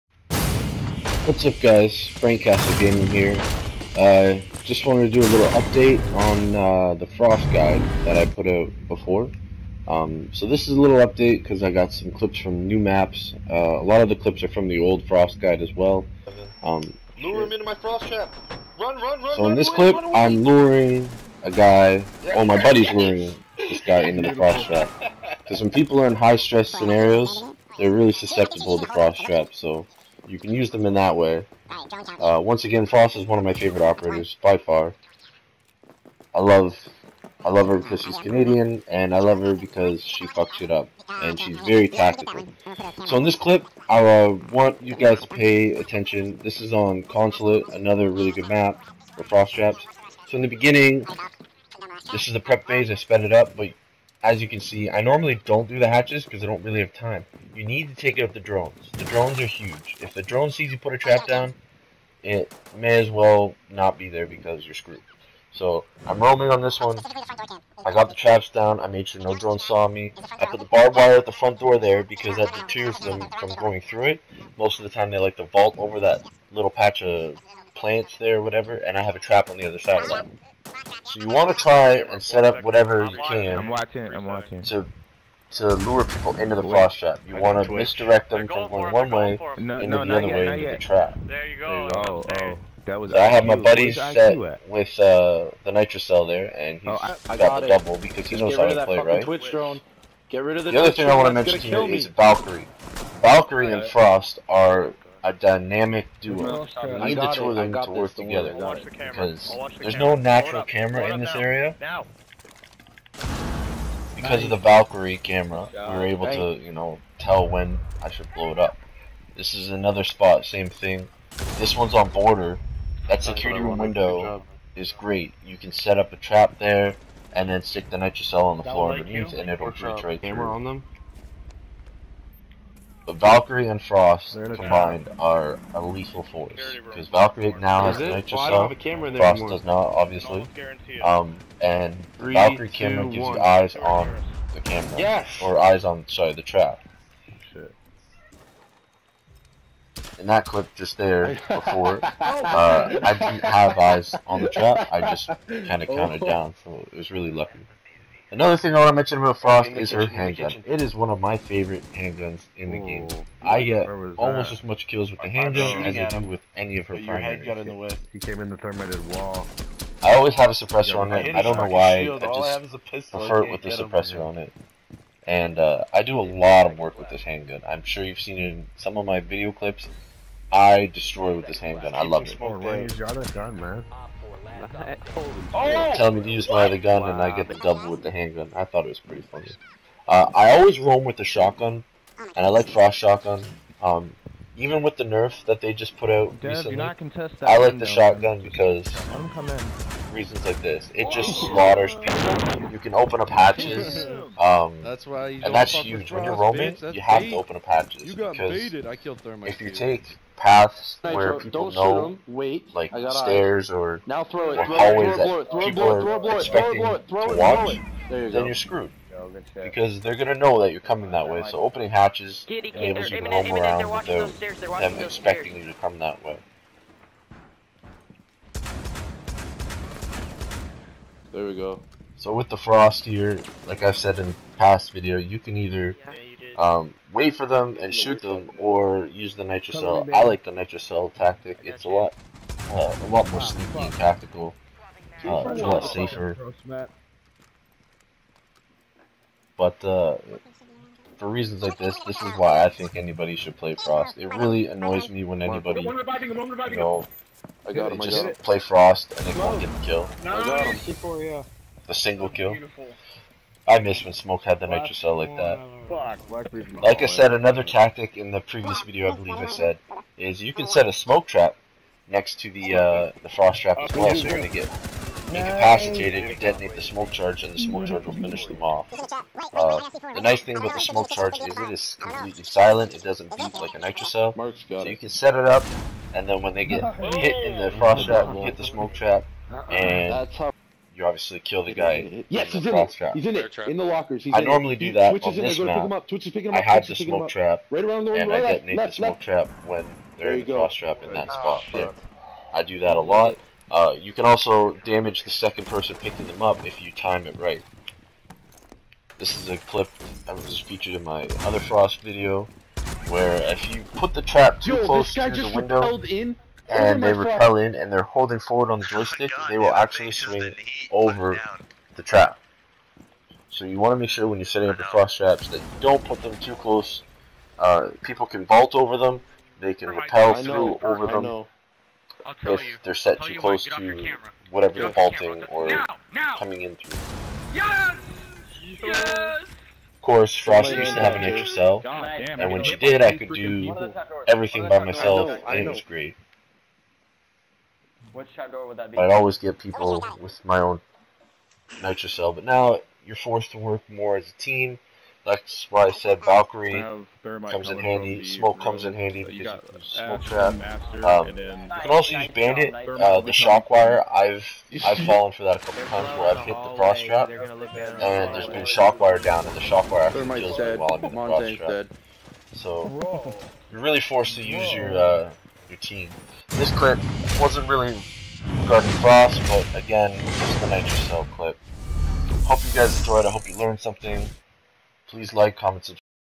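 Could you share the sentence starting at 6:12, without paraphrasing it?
So you're really forced to use your uh, your team.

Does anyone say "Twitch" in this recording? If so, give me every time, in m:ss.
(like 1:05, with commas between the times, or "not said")
1:39, 4:56.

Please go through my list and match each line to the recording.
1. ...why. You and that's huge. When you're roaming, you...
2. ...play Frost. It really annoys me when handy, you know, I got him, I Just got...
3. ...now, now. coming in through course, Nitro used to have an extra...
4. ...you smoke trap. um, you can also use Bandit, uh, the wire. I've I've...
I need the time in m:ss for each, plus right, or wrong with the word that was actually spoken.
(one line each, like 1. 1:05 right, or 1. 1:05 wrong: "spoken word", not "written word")
1. 3:25 right
2. 4:13 wrong: "anybody", not "handy"
3. 5:35 wrong: "Frost", not "Nitro"
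4. 5:59 right.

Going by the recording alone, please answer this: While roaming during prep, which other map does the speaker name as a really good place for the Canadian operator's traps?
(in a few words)
Consulate.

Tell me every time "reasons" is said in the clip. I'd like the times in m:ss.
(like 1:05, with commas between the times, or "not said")
3:20, 4:11.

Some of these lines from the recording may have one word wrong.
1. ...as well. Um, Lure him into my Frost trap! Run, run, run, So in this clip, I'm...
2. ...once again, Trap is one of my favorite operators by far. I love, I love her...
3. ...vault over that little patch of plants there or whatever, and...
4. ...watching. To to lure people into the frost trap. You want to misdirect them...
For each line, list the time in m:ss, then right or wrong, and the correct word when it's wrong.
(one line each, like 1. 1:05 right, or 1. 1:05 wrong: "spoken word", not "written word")
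1. 0:15 right
2. 0:32 wrong: "Frost", not "Trap"
3. 1:15 right
4. 1:24 right.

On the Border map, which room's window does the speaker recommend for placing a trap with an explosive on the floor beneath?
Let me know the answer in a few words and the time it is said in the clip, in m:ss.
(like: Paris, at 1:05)
security room, at 2:03.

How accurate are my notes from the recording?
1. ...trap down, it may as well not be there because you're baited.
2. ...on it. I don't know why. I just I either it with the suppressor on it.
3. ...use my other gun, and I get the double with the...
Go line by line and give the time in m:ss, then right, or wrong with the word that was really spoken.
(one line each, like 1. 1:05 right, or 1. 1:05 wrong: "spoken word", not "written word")
1. 1:00 wrong: "screwed", not "baited"
2. 2:50 wrong: "prefer", not "either"
3. 3:06 right.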